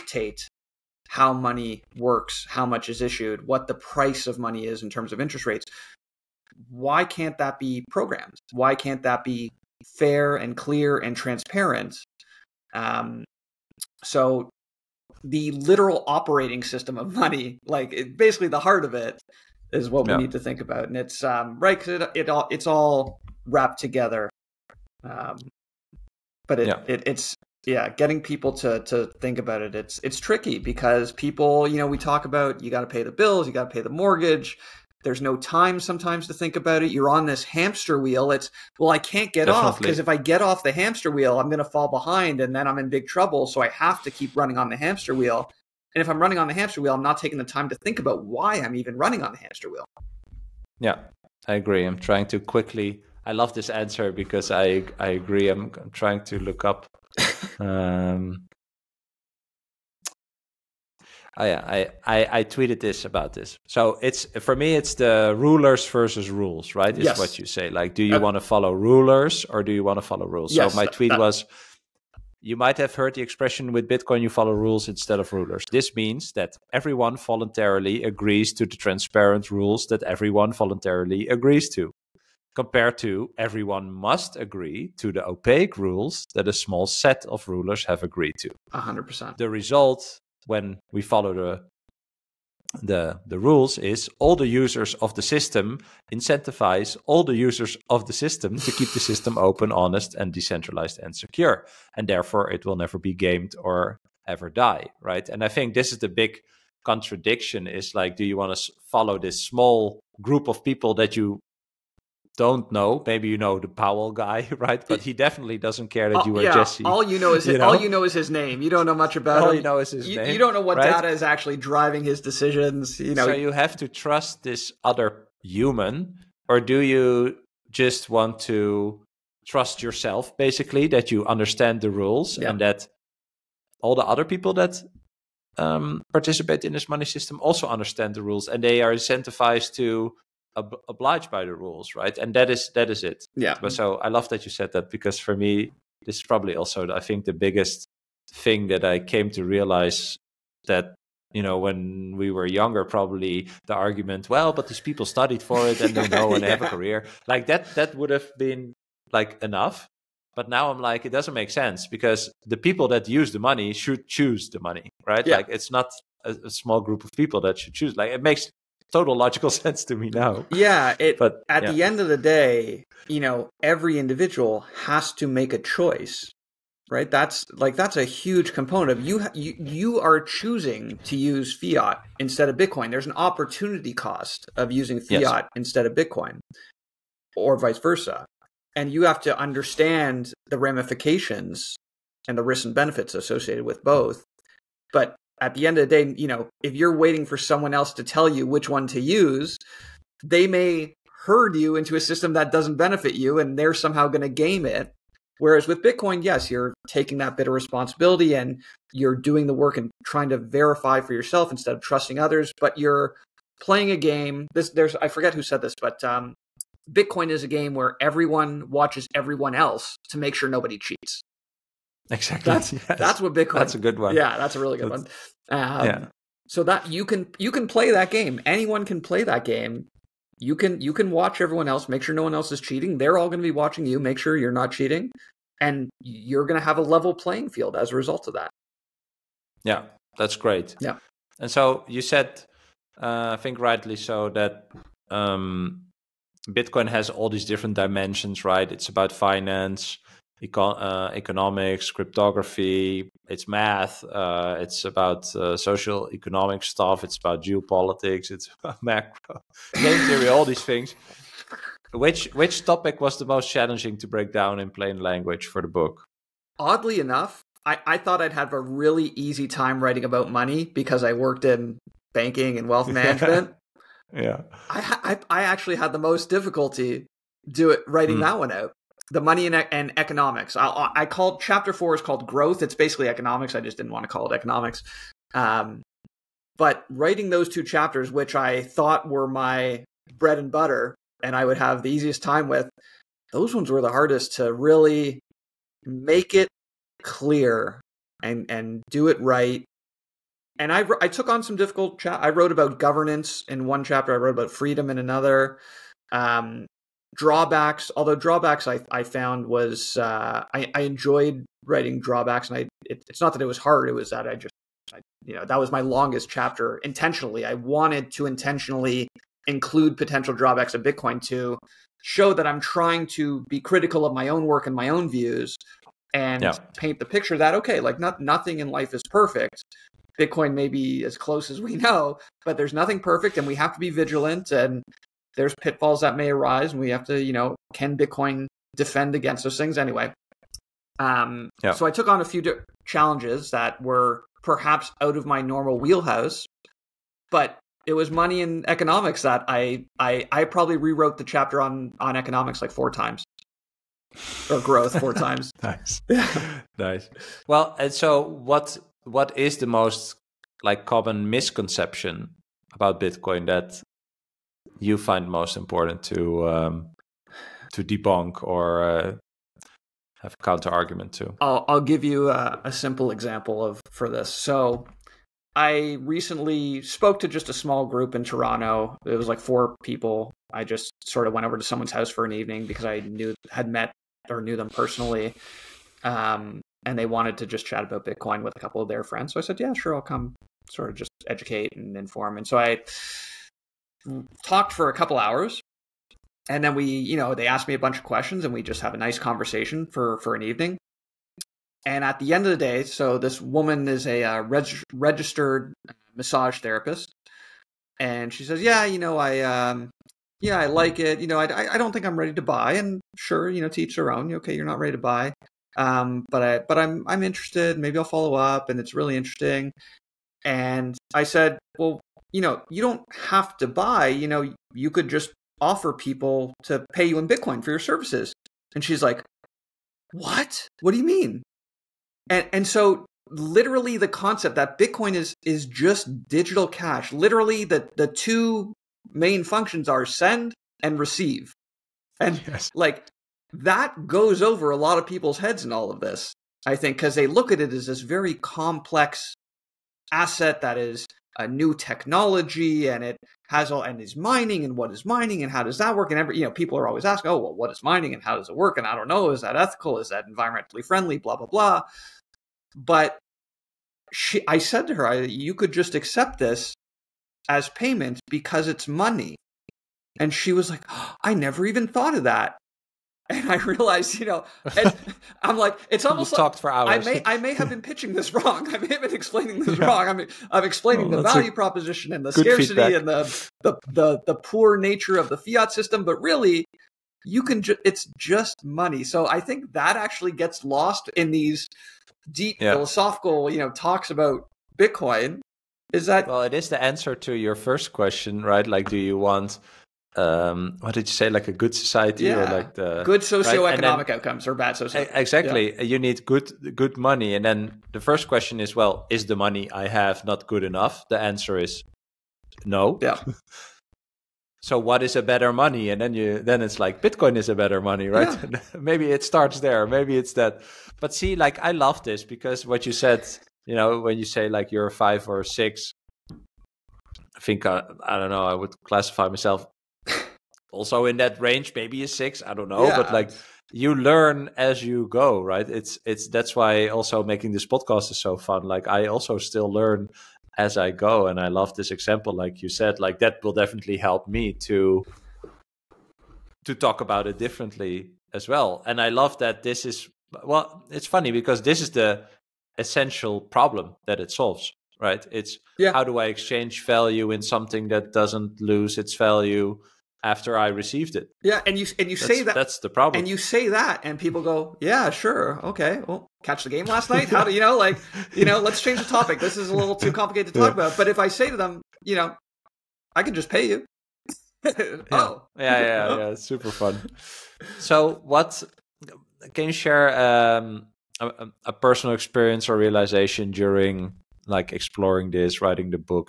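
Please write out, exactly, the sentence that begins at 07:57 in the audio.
I may, I may have been pitching this wrong.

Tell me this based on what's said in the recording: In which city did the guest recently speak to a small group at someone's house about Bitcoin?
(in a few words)
Toronto.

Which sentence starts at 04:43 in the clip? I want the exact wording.
I just didn't want to call it economics.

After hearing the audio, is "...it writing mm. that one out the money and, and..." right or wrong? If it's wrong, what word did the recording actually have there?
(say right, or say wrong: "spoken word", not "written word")
right.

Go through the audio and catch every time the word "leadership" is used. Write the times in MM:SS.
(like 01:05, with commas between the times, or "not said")
not said.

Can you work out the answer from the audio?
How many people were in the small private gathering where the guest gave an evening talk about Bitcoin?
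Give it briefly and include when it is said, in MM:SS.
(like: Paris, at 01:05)
4, at 06:19.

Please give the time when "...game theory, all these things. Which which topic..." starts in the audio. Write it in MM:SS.
04:19.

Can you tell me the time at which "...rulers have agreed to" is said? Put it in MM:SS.
01:27.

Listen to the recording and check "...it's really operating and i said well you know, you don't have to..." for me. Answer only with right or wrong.
wrong.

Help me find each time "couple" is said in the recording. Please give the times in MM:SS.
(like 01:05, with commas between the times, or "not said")
06:28, 06:34.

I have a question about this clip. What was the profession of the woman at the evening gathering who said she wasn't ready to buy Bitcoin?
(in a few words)
Registered massage therapist.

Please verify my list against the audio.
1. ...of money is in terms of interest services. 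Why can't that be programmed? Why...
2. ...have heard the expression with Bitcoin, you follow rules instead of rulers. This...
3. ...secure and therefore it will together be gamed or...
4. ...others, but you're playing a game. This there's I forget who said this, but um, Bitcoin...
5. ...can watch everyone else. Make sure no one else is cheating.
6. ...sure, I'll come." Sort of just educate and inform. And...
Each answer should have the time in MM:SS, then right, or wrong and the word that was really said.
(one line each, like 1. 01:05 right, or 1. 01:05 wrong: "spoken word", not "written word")
1. 00:04 wrong: "rates", not "services"
2. 01:12 right
3. 01:41 wrong: "never", not "together"
4. 03:32 right
5. 03:50 right
6. 06:29 right.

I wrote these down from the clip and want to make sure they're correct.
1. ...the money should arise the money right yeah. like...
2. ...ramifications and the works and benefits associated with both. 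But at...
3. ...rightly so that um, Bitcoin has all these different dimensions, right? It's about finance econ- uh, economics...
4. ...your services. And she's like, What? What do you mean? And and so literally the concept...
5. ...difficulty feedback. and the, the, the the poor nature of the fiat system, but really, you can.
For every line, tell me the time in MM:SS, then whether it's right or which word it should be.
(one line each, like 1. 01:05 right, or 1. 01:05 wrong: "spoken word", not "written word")
1. 02:43 wrong: "choose", not "arise"
2. 03:10 wrong: "risks", not "works"
3. 04:03 right
4. 07:07 right
5. 08:02 wrong: "scarcity", not "difficulty".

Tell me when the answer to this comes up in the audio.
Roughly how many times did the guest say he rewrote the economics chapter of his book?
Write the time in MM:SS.
05:52.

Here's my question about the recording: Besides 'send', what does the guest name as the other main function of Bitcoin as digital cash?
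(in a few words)
Receive.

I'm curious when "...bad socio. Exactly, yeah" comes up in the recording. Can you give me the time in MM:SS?
08:24.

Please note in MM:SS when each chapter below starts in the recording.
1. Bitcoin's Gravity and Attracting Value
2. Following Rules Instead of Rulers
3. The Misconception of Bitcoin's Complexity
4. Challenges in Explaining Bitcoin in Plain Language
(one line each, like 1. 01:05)
1. 01:52
2. 00:30
3. 05:31
4. 03:46.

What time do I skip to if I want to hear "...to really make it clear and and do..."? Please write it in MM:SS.
04:54.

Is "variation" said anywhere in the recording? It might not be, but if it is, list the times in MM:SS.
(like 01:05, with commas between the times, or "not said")
not said.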